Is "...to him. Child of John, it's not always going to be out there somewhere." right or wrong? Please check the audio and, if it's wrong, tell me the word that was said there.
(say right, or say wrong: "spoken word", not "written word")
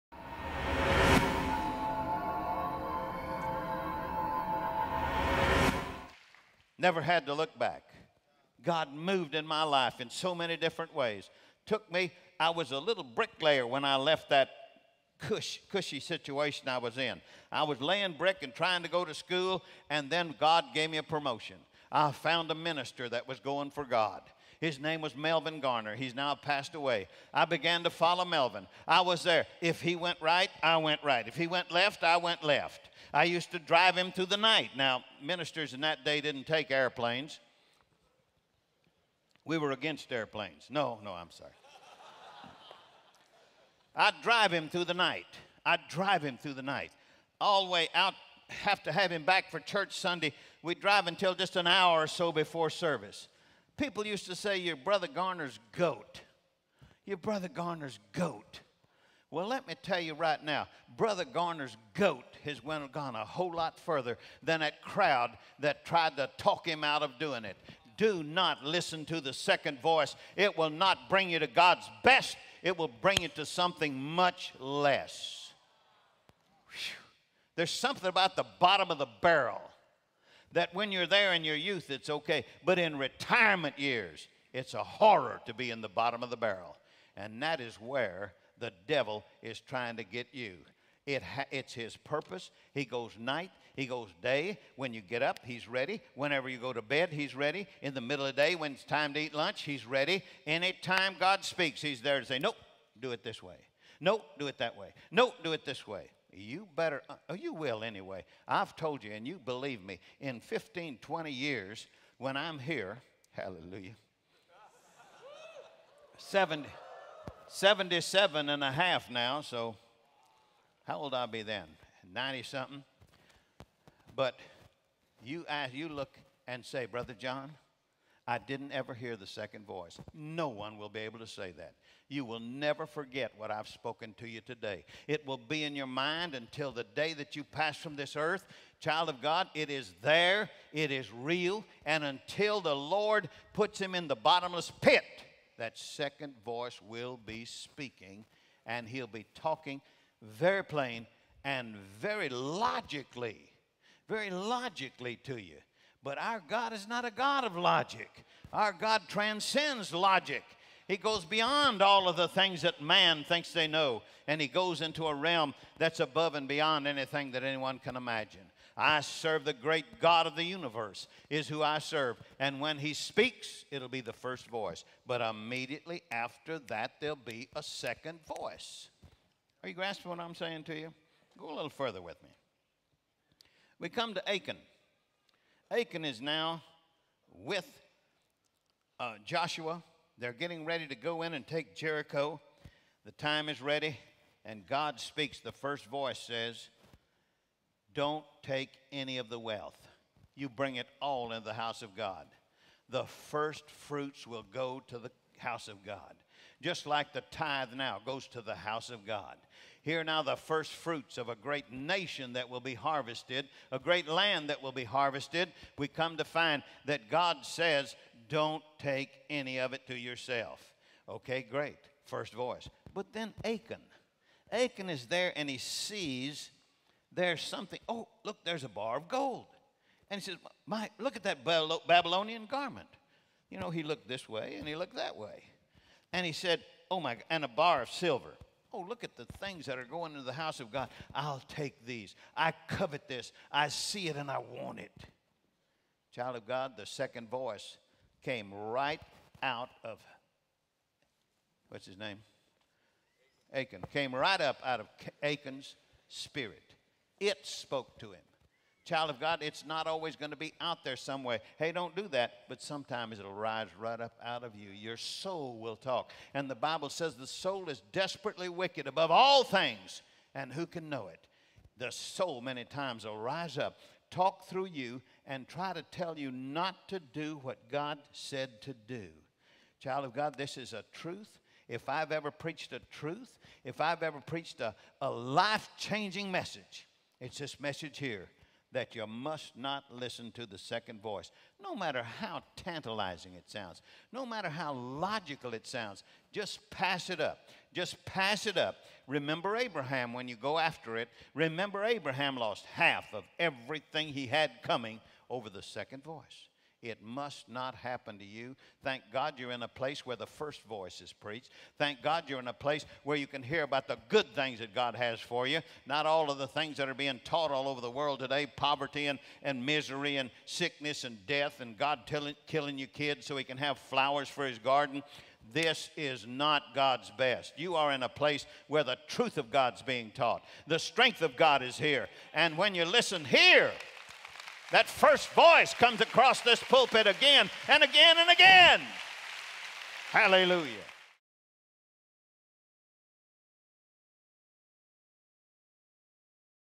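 wrong: "God", not "John".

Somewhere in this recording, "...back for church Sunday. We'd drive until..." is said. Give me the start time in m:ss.
0:49.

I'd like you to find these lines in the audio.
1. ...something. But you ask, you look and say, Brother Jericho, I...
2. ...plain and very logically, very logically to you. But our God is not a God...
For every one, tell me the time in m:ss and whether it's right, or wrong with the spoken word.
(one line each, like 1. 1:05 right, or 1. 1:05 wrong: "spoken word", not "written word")
1. 2:02 wrong: "John", not "Jericho"
2. 2:30 right.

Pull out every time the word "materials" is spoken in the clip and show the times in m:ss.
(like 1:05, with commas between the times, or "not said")
not said.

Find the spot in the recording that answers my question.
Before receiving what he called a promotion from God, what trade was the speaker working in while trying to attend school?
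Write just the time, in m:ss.
0:13.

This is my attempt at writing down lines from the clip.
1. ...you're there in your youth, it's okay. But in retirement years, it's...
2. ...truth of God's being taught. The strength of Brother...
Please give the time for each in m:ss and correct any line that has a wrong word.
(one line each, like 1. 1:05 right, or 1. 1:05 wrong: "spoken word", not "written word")
1. 1:20 right
2. 5:29 wrong: "God", not "Brother".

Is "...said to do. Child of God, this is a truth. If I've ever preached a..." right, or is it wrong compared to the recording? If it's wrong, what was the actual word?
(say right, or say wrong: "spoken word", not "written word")
right.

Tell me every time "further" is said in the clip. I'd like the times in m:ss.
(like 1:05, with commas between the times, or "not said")
1:03, 3:01.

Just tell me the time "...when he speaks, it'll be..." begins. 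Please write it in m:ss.
2:52.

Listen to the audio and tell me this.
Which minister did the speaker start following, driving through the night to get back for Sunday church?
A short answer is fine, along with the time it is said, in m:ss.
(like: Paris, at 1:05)
Melvin Garner, at 0:25.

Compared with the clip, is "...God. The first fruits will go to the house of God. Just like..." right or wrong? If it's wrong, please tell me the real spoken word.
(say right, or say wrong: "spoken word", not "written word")
right.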